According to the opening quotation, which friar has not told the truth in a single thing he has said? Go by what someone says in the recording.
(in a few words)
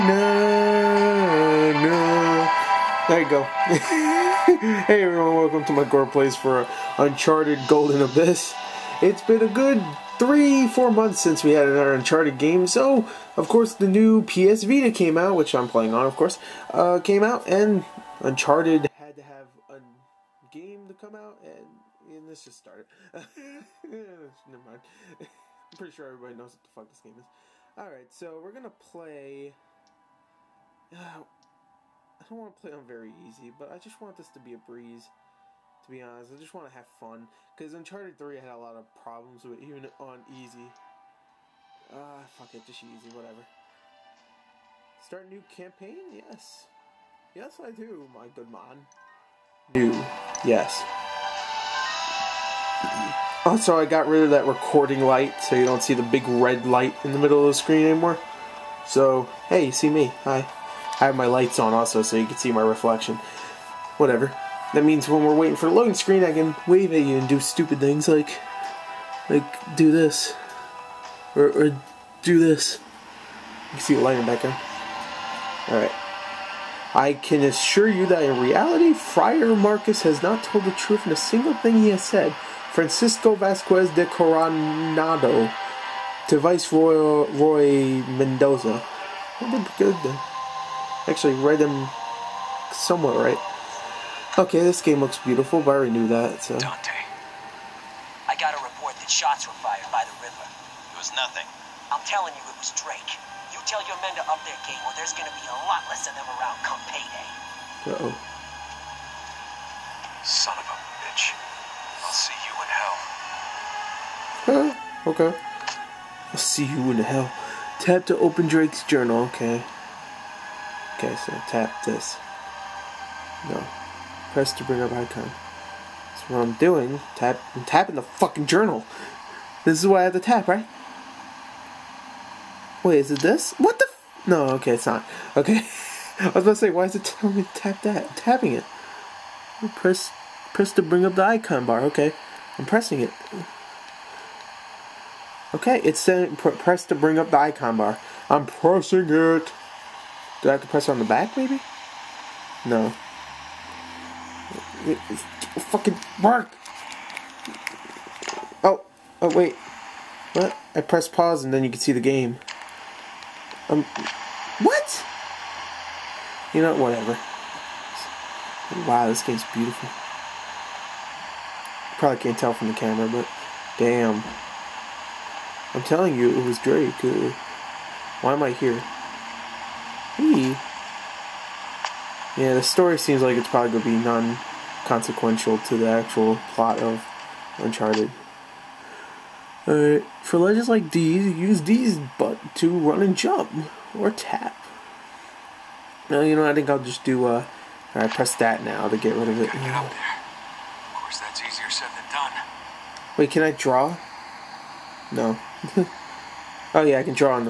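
Friar Marcus.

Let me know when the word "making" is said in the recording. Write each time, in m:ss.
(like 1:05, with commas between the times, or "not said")
not said.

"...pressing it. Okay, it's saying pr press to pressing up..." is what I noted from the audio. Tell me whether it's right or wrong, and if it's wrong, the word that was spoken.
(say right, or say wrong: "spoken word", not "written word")
wrong: "bring", not "pressing".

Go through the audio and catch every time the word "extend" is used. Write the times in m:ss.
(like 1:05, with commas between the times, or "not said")
not said.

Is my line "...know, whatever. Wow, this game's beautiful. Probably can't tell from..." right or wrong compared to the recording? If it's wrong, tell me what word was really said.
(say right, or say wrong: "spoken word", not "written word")
right.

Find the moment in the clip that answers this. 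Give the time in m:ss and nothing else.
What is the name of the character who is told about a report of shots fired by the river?
1:36.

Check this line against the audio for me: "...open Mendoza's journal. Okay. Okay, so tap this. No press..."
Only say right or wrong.
wrong.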